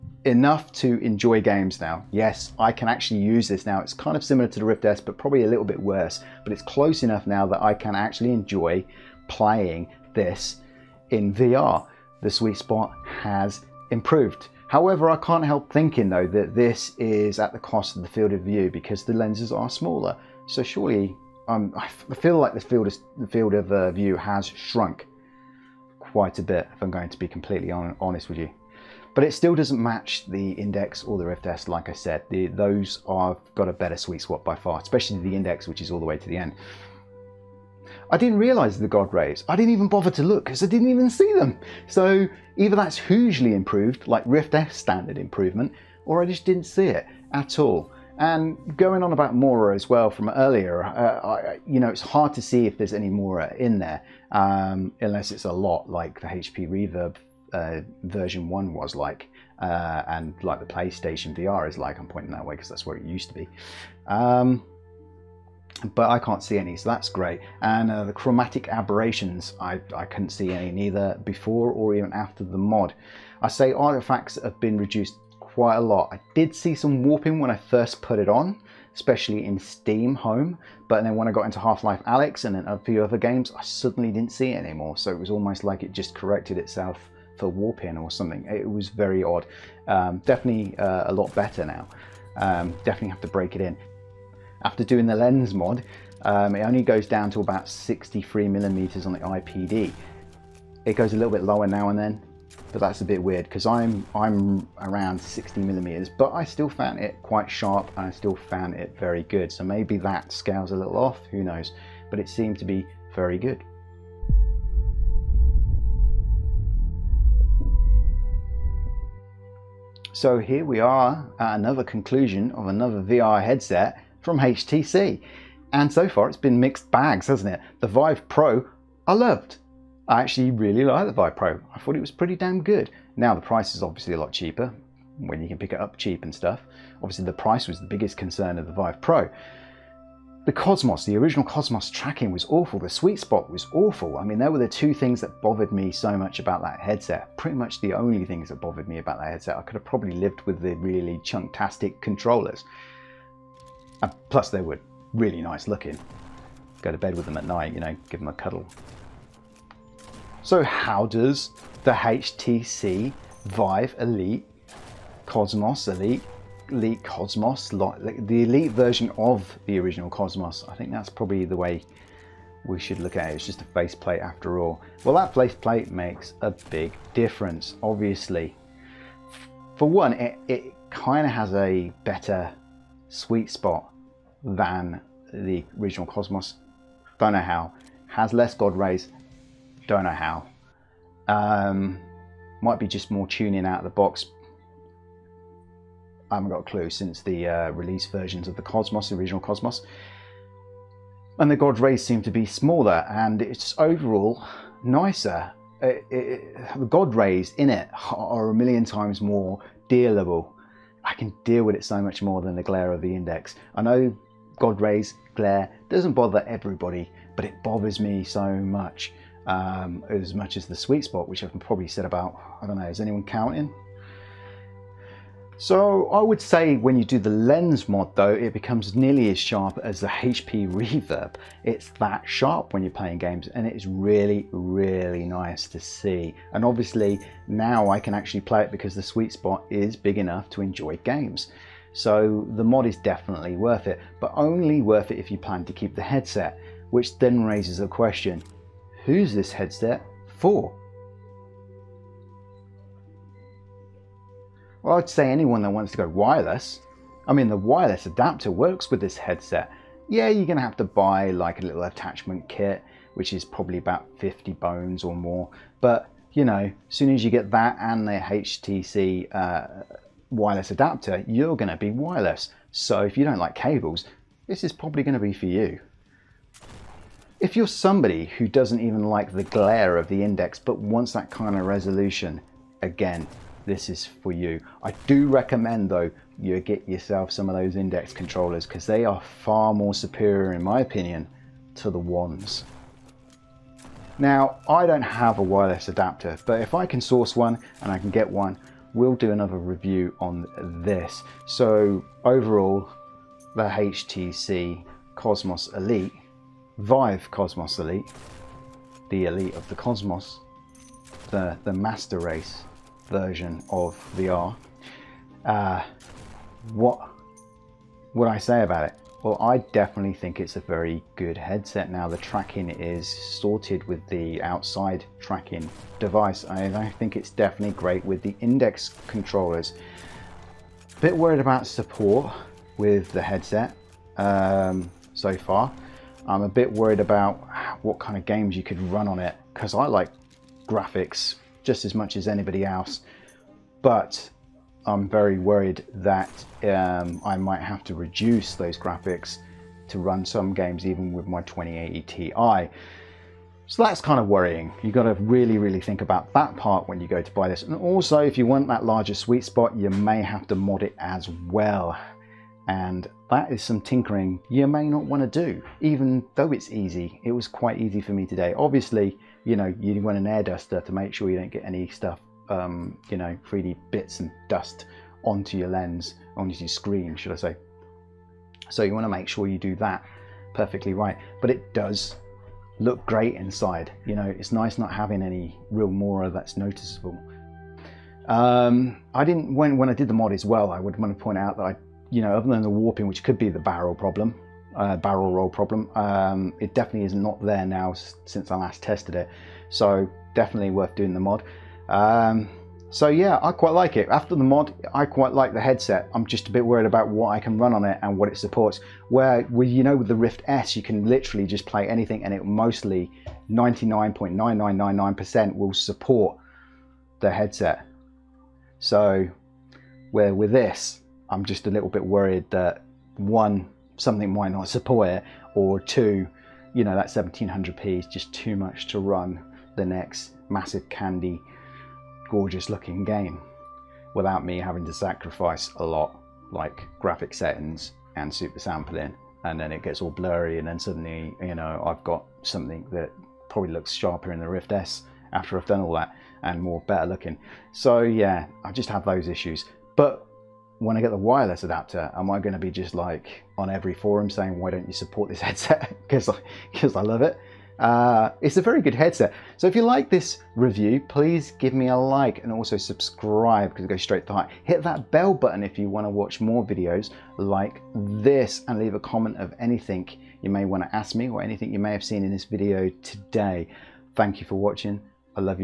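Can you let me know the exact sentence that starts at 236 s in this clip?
And obviously now I can actually play it because the sweet spot is big enough to enjoy games.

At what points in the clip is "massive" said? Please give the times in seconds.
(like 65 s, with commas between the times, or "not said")
430 s.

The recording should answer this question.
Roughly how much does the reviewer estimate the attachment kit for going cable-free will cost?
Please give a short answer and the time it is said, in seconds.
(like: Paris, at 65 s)
$50, at 264 s.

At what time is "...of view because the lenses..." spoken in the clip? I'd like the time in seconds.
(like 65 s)
18 s.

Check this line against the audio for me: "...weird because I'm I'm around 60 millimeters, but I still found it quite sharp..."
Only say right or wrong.
right.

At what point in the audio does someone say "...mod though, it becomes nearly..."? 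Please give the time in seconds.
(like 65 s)
227 s.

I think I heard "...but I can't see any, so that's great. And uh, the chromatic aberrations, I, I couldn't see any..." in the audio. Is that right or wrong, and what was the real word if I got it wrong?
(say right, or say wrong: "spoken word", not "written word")
right.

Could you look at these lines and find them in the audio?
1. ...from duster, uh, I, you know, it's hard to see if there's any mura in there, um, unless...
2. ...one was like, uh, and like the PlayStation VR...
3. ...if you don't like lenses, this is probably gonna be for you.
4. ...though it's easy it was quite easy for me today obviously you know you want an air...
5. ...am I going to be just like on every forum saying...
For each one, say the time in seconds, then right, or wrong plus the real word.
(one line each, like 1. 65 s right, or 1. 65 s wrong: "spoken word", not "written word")
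1. 50 s wrong: "earlier", not "duster"
2. 58 s right
3. 273 s wrong: "cables", not "lenses"
4. 366 s right
5. 452 s right.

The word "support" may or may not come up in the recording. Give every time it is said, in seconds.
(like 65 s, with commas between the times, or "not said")
331 s, 408 s, 415 s, 424 s, 454 s.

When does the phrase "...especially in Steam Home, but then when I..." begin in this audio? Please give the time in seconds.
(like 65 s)
78 s.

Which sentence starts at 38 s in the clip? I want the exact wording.
I didn't realize the God Rays.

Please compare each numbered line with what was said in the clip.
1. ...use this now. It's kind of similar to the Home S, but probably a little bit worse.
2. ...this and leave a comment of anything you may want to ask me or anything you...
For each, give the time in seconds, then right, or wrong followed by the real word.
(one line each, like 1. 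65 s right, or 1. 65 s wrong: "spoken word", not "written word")
1. 3 s wrong: "Rift", not "Home"
2. 467 s right.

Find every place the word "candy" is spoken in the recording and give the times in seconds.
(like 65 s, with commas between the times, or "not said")
430 s.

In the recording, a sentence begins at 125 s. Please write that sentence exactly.
And so far it's been mixed bags, hasn't it?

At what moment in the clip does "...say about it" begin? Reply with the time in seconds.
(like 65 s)
318 s.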